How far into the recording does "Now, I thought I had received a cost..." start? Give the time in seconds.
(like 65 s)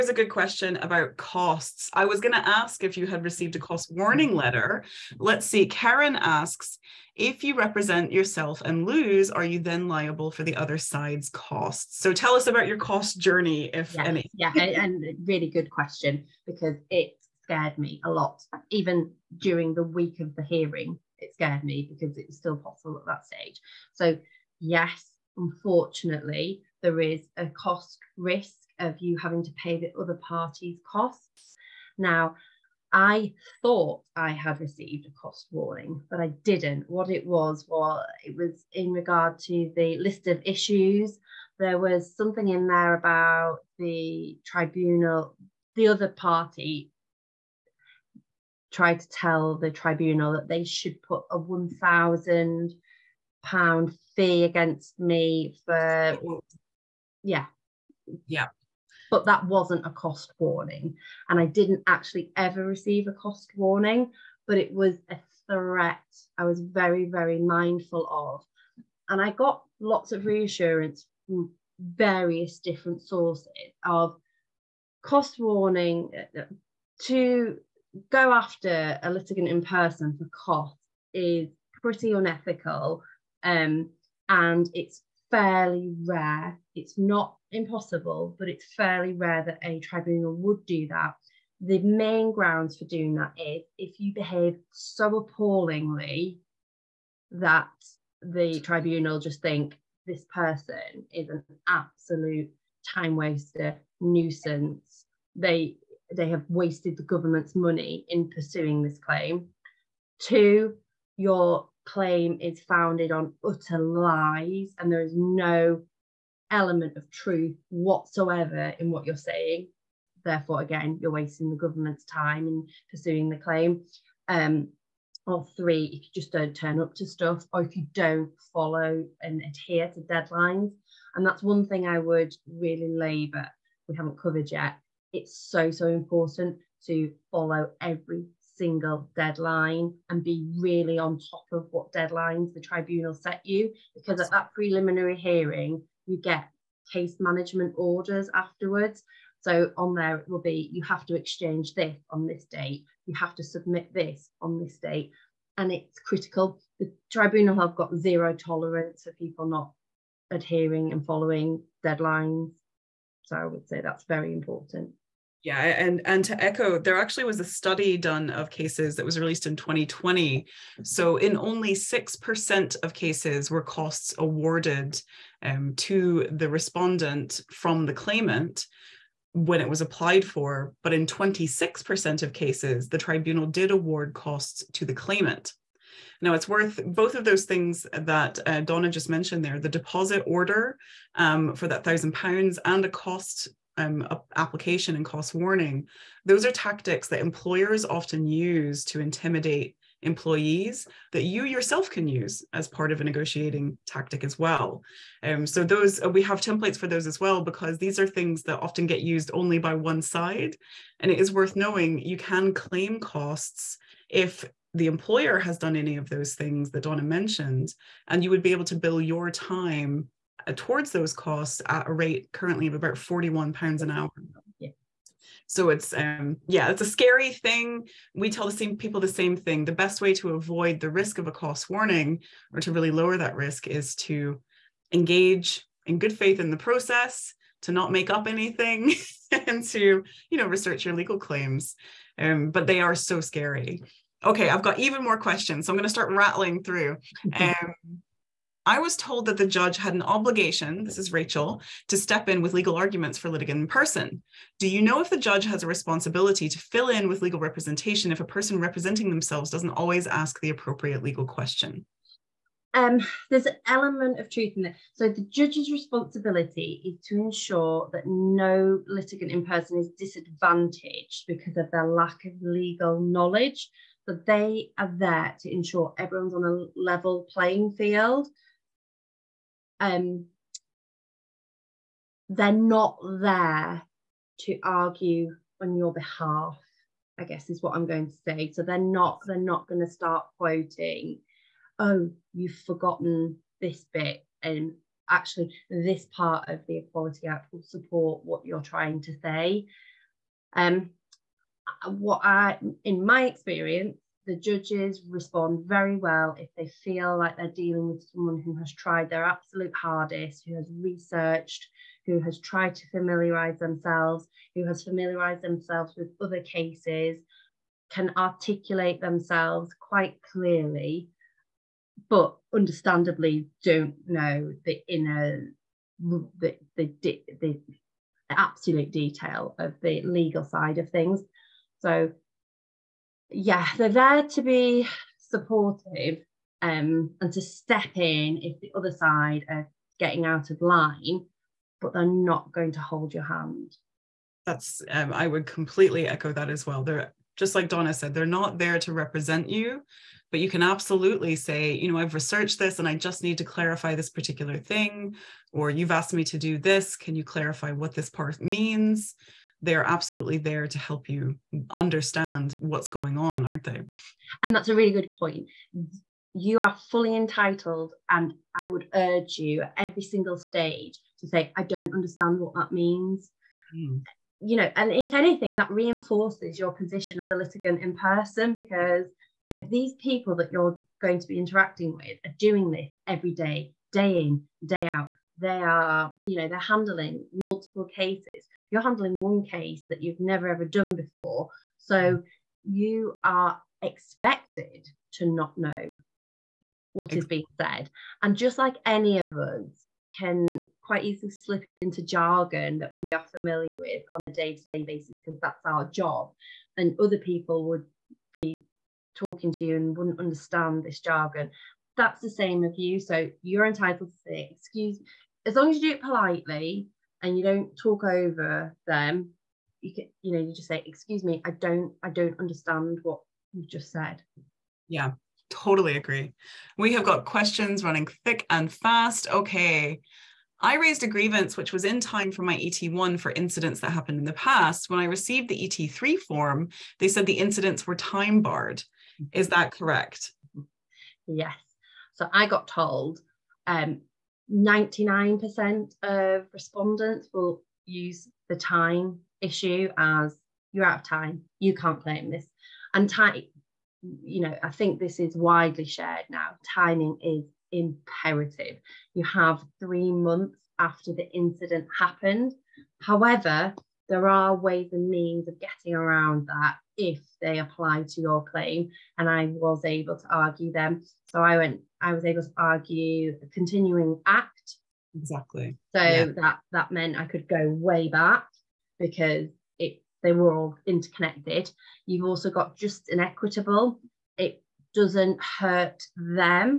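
31 s.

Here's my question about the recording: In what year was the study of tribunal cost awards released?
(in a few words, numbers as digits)
2020.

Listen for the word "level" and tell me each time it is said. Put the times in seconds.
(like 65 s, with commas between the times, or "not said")
276 s.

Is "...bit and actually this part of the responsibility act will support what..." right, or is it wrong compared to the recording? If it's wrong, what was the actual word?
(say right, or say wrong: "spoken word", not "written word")
wrong: "equality", not "responsibility".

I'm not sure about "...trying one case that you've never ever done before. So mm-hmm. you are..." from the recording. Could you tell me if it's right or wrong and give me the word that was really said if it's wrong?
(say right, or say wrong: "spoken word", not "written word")
wrong: "handling", not "trying".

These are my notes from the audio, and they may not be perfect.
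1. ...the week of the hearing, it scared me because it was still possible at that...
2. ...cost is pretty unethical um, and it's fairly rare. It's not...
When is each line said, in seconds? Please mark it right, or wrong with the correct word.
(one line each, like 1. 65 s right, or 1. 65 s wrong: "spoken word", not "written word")
1. 19 s right
2. 80 s right.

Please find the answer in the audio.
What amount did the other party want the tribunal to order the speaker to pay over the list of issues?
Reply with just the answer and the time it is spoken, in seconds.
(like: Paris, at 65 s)
£1,000, at 51 s.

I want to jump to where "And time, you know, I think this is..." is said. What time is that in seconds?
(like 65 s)
452 s.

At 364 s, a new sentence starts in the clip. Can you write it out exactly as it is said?
And that's a really good point.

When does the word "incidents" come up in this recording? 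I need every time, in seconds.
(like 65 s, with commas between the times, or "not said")
433 s, 437 s, 461 s.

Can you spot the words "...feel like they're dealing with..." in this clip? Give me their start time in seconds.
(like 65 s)
306 s.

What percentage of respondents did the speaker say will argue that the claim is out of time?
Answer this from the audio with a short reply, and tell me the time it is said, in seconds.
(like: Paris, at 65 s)
99%, at 444 s.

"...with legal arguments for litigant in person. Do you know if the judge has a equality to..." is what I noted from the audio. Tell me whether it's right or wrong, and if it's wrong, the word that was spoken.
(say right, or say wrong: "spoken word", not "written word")
wrong: "responsibility", not "equality".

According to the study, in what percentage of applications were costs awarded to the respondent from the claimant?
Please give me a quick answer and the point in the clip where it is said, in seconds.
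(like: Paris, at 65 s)
6%, at 171 s.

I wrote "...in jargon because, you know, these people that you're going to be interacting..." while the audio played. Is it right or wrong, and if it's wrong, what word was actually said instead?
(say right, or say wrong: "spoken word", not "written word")
wrong: "person", not "jargon".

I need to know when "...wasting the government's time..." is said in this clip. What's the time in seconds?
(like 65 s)
121 s.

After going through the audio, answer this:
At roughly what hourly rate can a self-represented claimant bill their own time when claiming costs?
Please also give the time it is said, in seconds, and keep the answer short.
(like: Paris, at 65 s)
£41 an hour, at 222 s.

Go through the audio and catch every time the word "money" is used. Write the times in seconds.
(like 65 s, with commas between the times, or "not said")
107 s.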